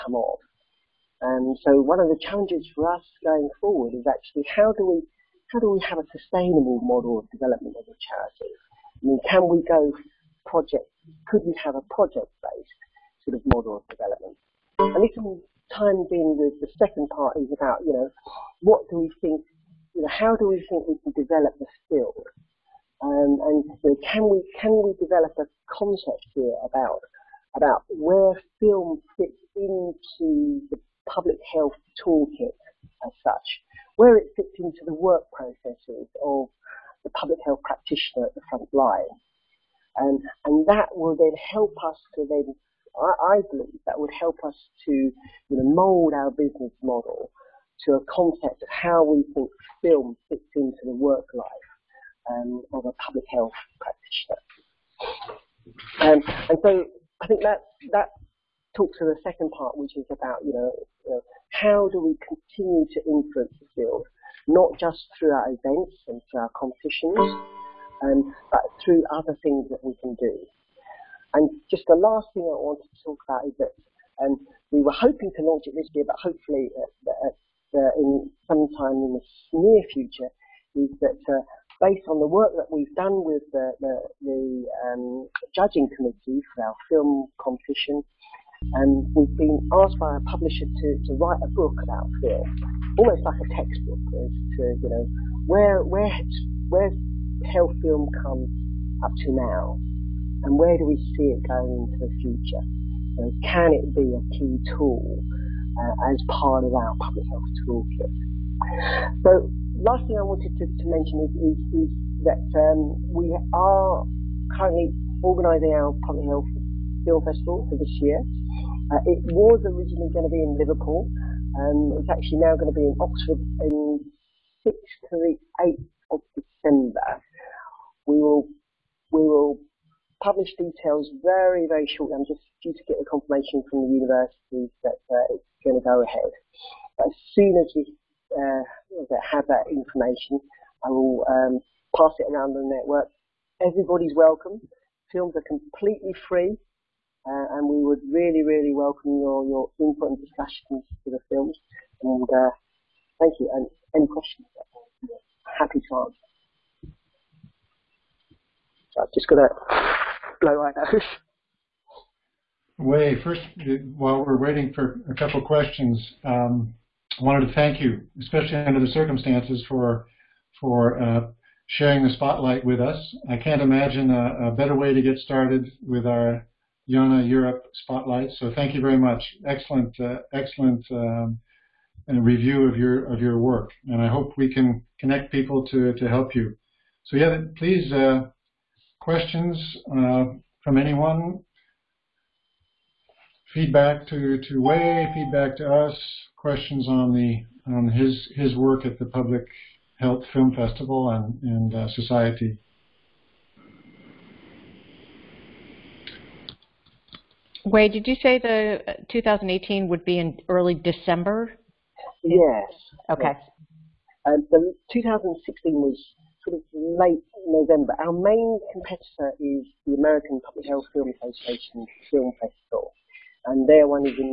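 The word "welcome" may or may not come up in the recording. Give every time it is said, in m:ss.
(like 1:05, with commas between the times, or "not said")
2:24, 2:28.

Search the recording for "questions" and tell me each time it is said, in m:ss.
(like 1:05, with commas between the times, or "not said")
2:34, 2:45, 3:09, 3:16.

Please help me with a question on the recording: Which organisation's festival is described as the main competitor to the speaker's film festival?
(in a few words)
American Public Health Film Association.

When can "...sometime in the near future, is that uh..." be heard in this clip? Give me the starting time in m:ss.
1:18.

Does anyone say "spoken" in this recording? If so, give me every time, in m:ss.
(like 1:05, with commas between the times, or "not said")
not said.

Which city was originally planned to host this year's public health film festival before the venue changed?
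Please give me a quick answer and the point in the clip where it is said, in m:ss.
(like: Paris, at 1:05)
Liverpool, at 2:00.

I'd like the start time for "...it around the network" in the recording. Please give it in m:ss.
2:22.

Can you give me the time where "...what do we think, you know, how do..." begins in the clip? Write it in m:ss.
0:18.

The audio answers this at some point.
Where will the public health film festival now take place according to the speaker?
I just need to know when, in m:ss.
2:02.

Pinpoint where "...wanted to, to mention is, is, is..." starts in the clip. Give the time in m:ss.
1:50.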